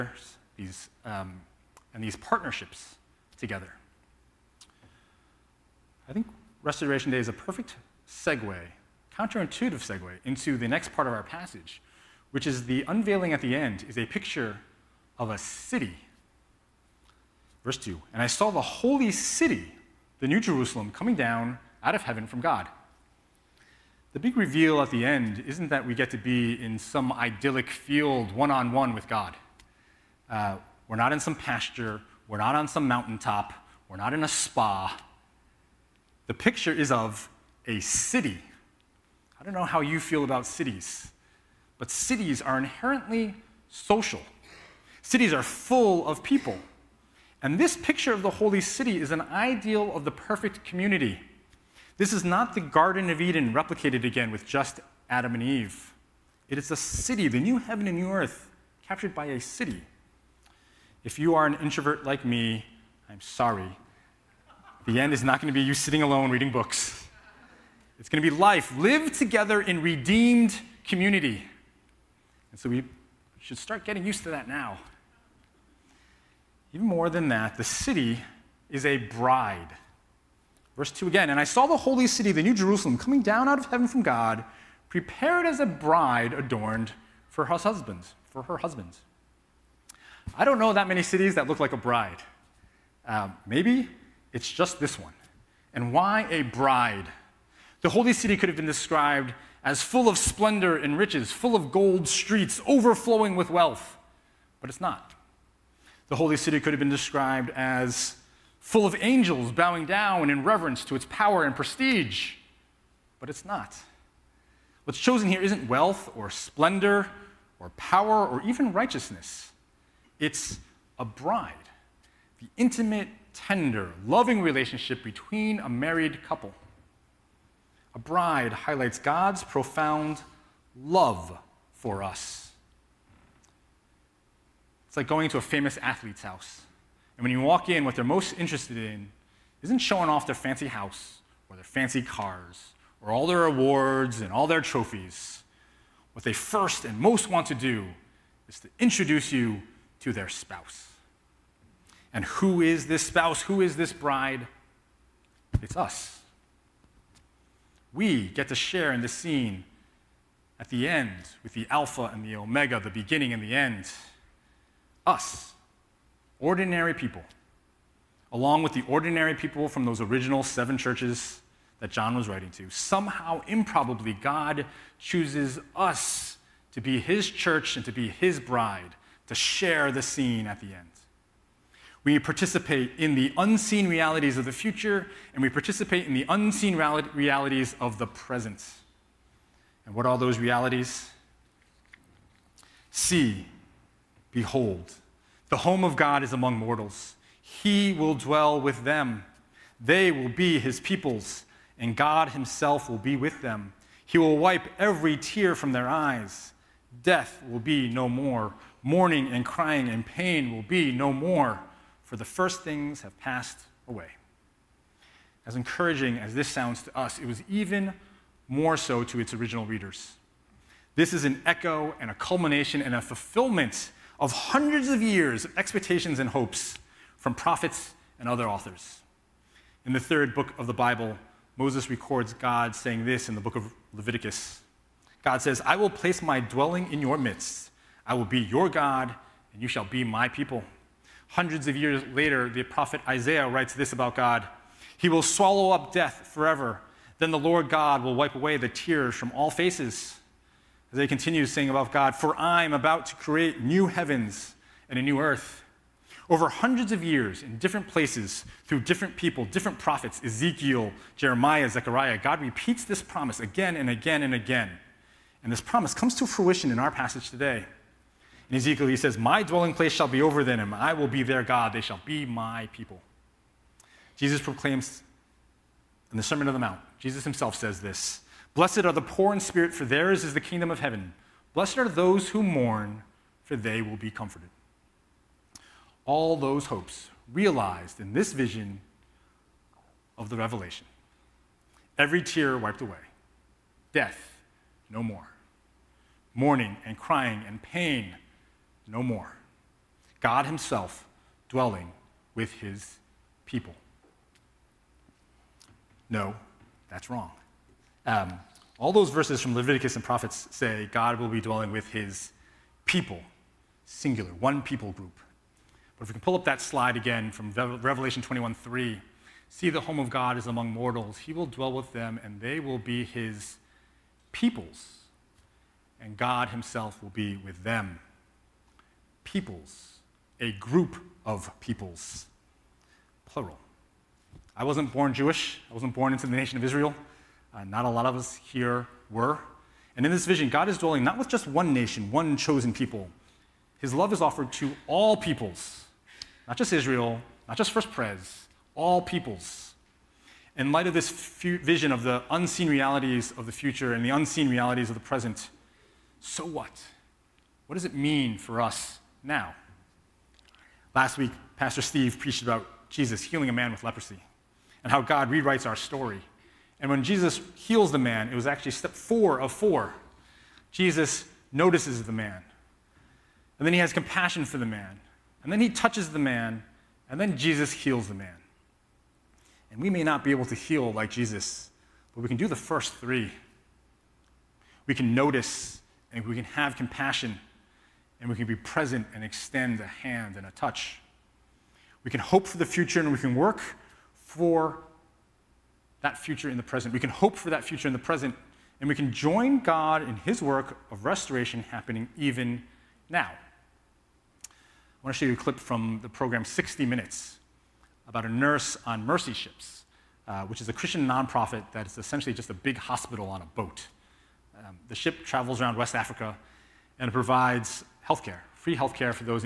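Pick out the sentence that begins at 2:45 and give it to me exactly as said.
Us, ordinary people, along with the ordinary people from those original seven churches that John was writing to.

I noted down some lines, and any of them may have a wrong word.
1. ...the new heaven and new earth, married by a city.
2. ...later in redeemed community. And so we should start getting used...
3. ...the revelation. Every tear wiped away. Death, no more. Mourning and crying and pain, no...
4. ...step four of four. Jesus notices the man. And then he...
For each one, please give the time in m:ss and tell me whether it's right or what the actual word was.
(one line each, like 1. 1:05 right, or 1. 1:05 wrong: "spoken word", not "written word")
1. 0:57 wrong: "captured", not "married"
2. 1:09 wrong: "together", not "later"
3. 4:50 right
4. 6:08 right.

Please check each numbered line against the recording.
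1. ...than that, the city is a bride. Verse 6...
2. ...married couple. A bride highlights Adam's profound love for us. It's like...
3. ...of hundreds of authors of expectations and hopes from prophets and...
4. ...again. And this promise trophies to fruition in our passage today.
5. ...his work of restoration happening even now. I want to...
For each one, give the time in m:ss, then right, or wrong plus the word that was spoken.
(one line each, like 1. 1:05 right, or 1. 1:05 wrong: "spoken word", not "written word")
1. 1:17 wrong: "2", not "6"
2. 2:05 wrong: "God", not "Adam"
3. 3:44 wrong: "years", not "authors"
4. 4:24 wrong: "comes", not "trophies"
5. 6:40 right.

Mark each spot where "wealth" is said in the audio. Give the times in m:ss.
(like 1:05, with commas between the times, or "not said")
1:43, 1:55.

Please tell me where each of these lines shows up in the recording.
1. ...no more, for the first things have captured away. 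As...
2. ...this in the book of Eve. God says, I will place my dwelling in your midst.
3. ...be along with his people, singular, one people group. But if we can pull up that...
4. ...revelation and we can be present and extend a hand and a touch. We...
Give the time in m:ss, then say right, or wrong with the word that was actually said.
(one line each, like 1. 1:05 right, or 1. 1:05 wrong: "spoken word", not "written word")
1. 3:30 wrong: "passed", not "captured"
2. 3:53 wrong: "Leviticus", not "Eve"
3. 5:11 wrong: "dwelling", not "along"
4. 6:26 wrong: "compassion", not "revelation".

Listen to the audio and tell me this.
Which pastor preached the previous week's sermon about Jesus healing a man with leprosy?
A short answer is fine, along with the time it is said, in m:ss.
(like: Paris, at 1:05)
Pastor Steve, at 6:01.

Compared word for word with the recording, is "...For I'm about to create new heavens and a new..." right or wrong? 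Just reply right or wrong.
right.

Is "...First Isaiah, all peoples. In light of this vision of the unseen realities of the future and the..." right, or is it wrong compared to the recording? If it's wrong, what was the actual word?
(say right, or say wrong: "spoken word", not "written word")
wrong: "Pres", not "Isaiah".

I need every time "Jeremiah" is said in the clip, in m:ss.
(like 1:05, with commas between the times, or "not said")
4:21.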